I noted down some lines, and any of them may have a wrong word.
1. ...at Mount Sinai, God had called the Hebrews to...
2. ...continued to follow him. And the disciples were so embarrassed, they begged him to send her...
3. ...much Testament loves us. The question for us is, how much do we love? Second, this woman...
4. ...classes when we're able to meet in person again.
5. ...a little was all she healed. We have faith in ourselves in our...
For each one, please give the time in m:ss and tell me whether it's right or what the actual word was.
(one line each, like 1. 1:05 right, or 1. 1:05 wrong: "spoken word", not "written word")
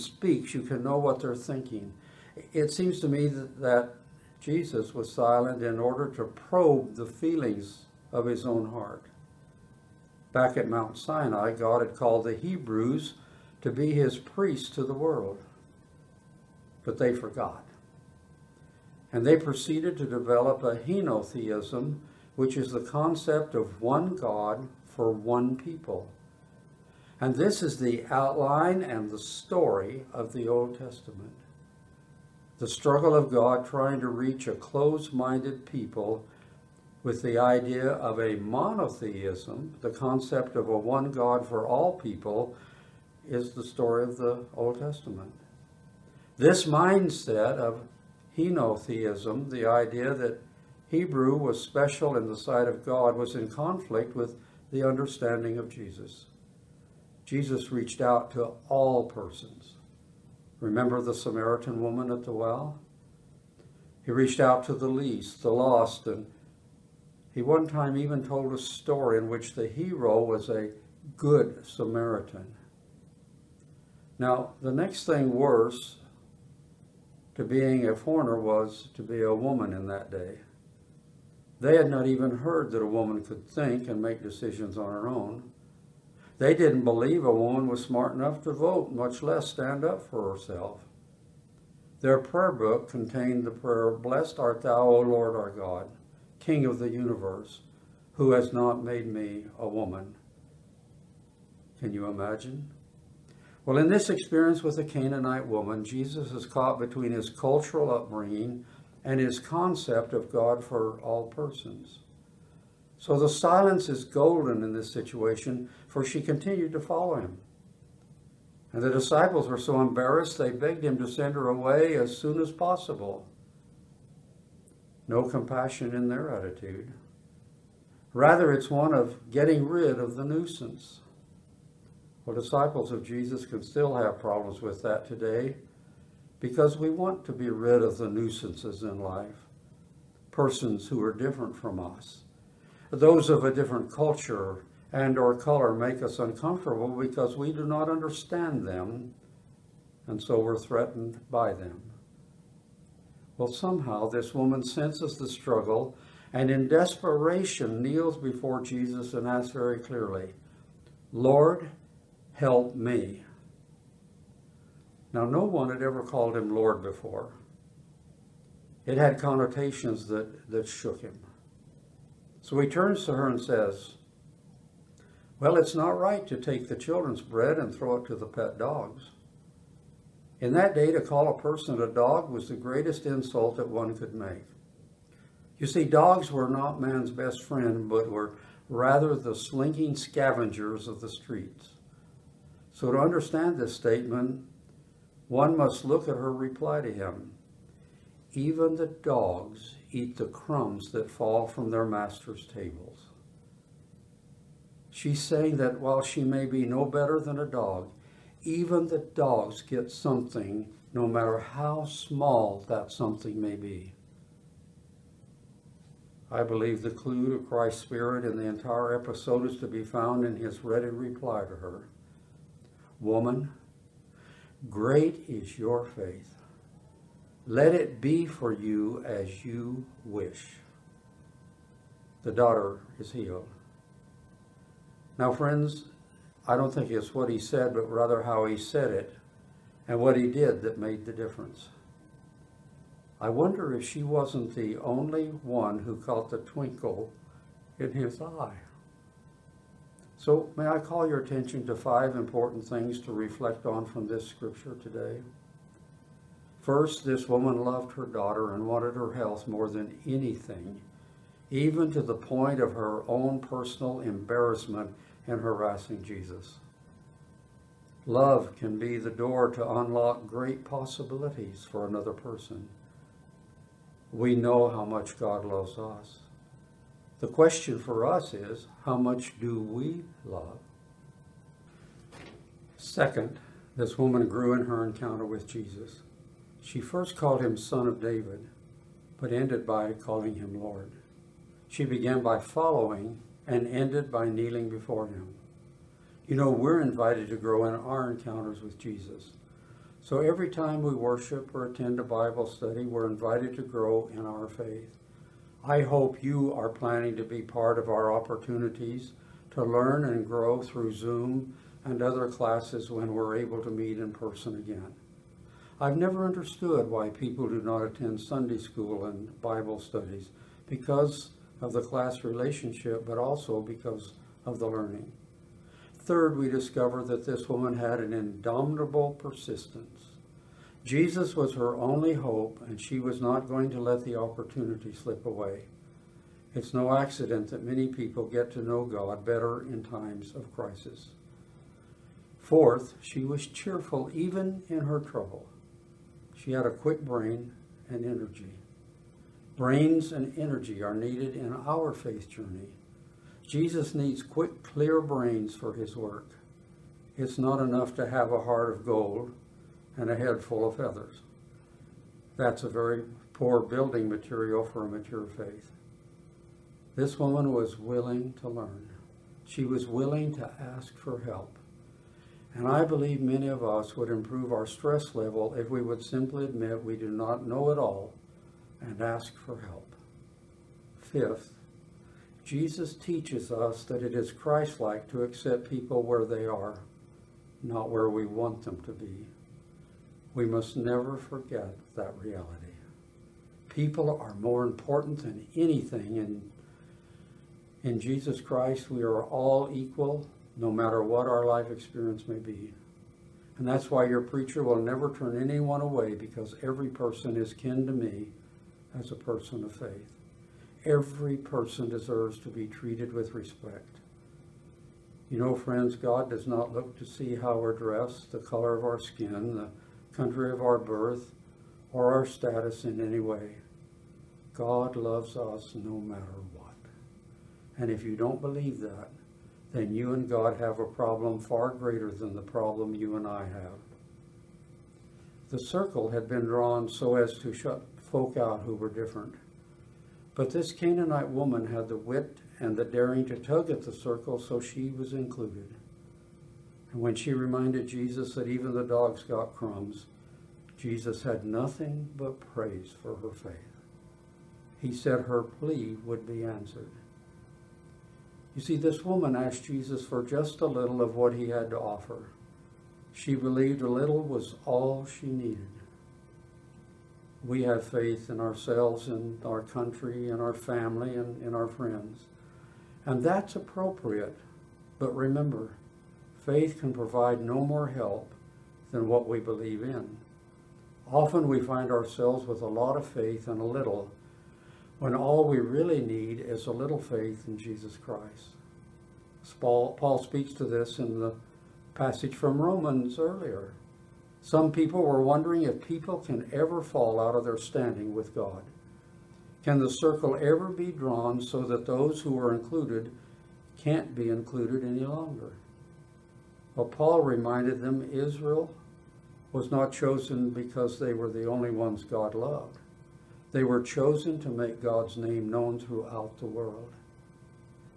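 1. 0:10 right
2. 1:56 right
3. 4:34 wrong: "God", not "Testament"
4. 5:12 right
5. 7:43 wrong: "needed", not "healed".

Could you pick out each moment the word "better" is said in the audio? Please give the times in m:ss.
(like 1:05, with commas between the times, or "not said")
3:26, 5:39.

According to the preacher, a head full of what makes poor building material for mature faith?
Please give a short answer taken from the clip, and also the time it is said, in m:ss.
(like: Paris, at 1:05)
feathers, at 6:00.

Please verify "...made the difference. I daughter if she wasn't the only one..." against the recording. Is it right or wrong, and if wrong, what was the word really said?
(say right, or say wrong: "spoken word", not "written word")
wrong: "wonder", not "daughter".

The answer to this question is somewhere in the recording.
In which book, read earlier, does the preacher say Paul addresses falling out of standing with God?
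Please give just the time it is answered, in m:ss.
8:12.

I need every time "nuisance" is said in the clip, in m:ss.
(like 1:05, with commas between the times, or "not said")
2:10, 2:18.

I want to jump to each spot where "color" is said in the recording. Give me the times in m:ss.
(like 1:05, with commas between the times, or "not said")
2:25, 6:58.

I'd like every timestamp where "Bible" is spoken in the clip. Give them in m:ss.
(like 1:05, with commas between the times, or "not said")
5:02, 5:19.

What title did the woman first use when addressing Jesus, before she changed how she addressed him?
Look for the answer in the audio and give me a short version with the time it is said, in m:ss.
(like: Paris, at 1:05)
Son of David, at 4:47.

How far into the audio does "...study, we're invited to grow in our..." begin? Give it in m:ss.
5:02.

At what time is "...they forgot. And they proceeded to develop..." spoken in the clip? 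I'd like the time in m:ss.
0:16.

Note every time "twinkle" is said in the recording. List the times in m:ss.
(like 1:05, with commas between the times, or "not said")
4:06.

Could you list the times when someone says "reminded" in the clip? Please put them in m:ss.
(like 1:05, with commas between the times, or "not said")
7:27, 8:27.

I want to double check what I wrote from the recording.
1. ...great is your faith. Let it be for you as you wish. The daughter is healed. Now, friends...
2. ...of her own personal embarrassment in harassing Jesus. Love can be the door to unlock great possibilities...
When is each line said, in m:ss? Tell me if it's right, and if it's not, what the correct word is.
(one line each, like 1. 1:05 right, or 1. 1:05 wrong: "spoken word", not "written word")
1. 3:44 right
2. 4:22 right.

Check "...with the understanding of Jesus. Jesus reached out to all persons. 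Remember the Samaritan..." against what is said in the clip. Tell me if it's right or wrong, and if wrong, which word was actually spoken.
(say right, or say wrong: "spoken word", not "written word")
right.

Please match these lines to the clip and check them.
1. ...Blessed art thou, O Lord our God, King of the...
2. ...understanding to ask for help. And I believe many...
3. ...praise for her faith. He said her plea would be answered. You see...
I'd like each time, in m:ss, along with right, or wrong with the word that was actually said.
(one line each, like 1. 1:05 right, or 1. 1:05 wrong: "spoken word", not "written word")
1. 1:33 right
2. 6:09 wrong: "willing", not "understanding"
3. 7:32 right.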